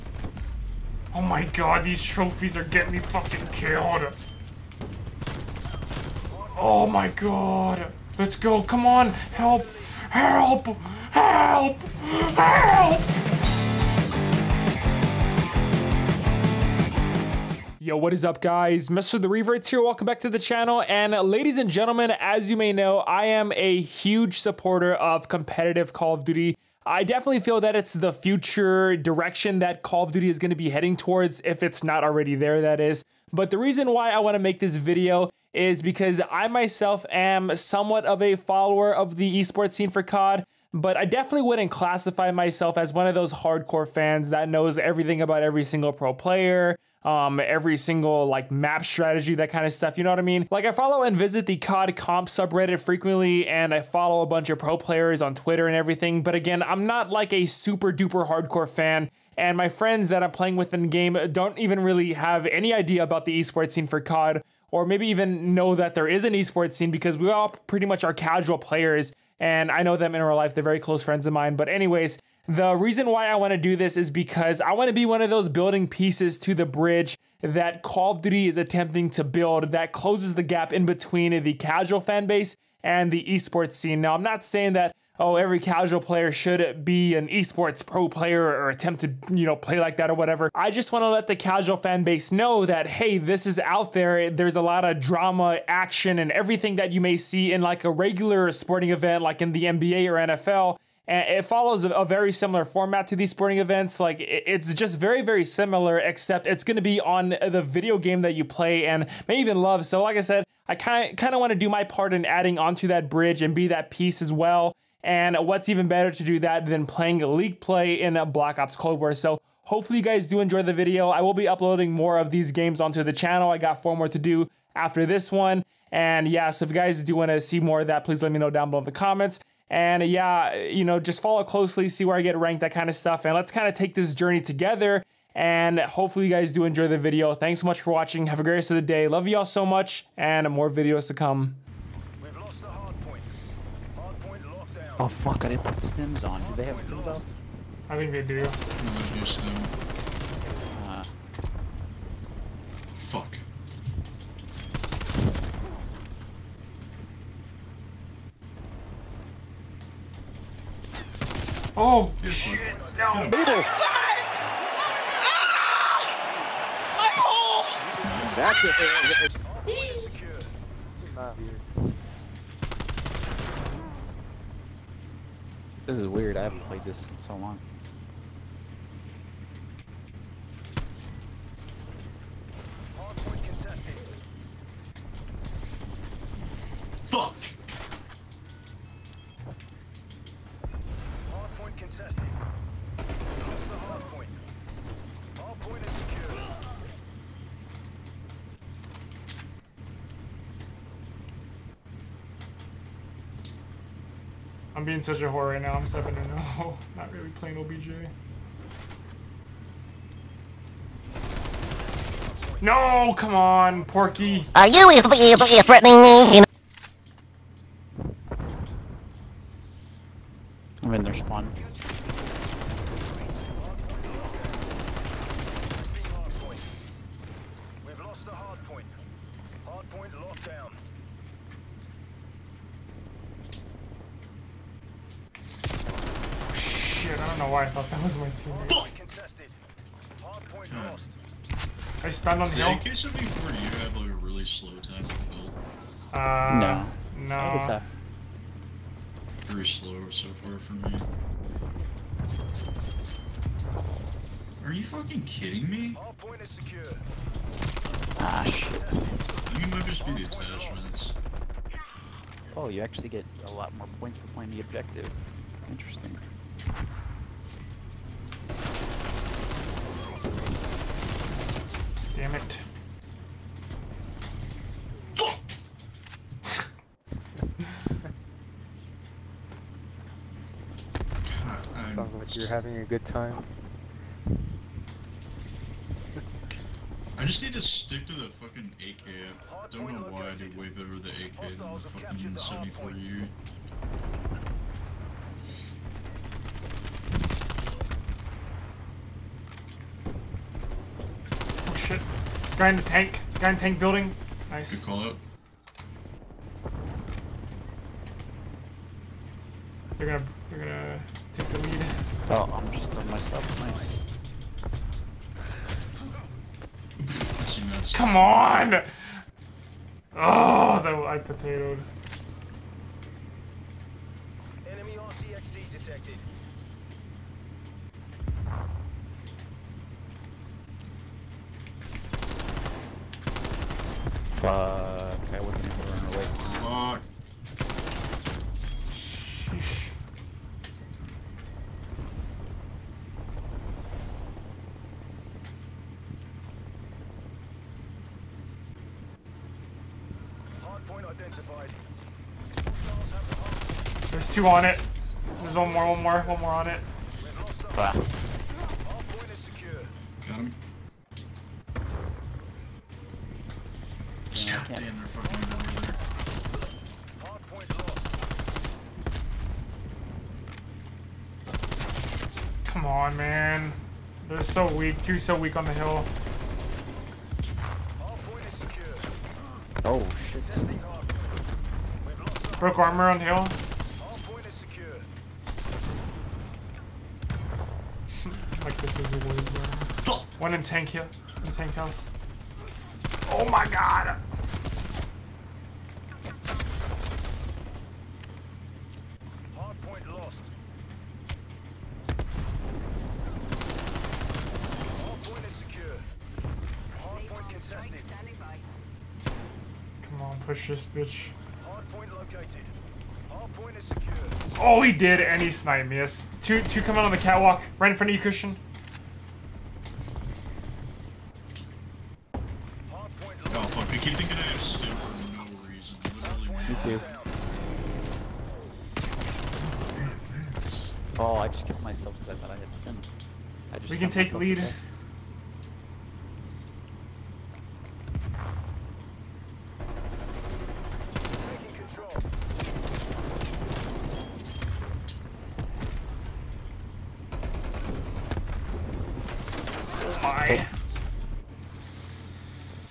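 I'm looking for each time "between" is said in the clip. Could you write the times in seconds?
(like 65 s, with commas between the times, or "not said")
80 s.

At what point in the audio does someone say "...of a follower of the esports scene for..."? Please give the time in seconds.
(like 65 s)
38 s.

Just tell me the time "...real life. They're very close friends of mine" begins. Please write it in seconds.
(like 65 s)
70 s.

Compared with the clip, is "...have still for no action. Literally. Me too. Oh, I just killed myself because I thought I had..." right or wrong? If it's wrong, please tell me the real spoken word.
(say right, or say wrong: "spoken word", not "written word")
wrong: "reason", not "action".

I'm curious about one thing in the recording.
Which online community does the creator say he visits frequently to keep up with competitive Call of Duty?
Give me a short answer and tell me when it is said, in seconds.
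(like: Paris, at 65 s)
COD comp subreddit, at 51 s.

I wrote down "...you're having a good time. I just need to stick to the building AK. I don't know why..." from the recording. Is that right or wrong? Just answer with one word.
wrong.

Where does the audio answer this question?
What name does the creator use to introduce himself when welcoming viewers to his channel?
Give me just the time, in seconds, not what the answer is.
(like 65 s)
18 s.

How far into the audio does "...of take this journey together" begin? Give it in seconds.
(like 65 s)
133 s.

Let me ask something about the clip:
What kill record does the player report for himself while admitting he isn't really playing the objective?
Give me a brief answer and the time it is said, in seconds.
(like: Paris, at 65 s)
7 to 0, at 205 s.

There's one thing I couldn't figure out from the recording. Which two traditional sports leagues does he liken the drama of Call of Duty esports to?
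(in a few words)
NBA or NFL.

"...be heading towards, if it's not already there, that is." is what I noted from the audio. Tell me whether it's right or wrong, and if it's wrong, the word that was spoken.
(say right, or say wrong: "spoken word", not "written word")
right.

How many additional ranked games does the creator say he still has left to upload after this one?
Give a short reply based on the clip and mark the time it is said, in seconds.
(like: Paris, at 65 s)
4, at 123 s.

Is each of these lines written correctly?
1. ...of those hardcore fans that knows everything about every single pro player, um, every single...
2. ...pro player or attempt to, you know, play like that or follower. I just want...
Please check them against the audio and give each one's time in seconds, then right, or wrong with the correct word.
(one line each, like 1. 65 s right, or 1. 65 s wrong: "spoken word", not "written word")
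1. 43 s right
2. 87 s wrong: "whatever", not "follower".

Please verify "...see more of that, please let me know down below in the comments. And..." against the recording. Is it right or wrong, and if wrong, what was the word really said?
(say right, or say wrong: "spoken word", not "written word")
right.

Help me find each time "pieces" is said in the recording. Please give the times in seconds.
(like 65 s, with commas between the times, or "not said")
75 s, 113 s.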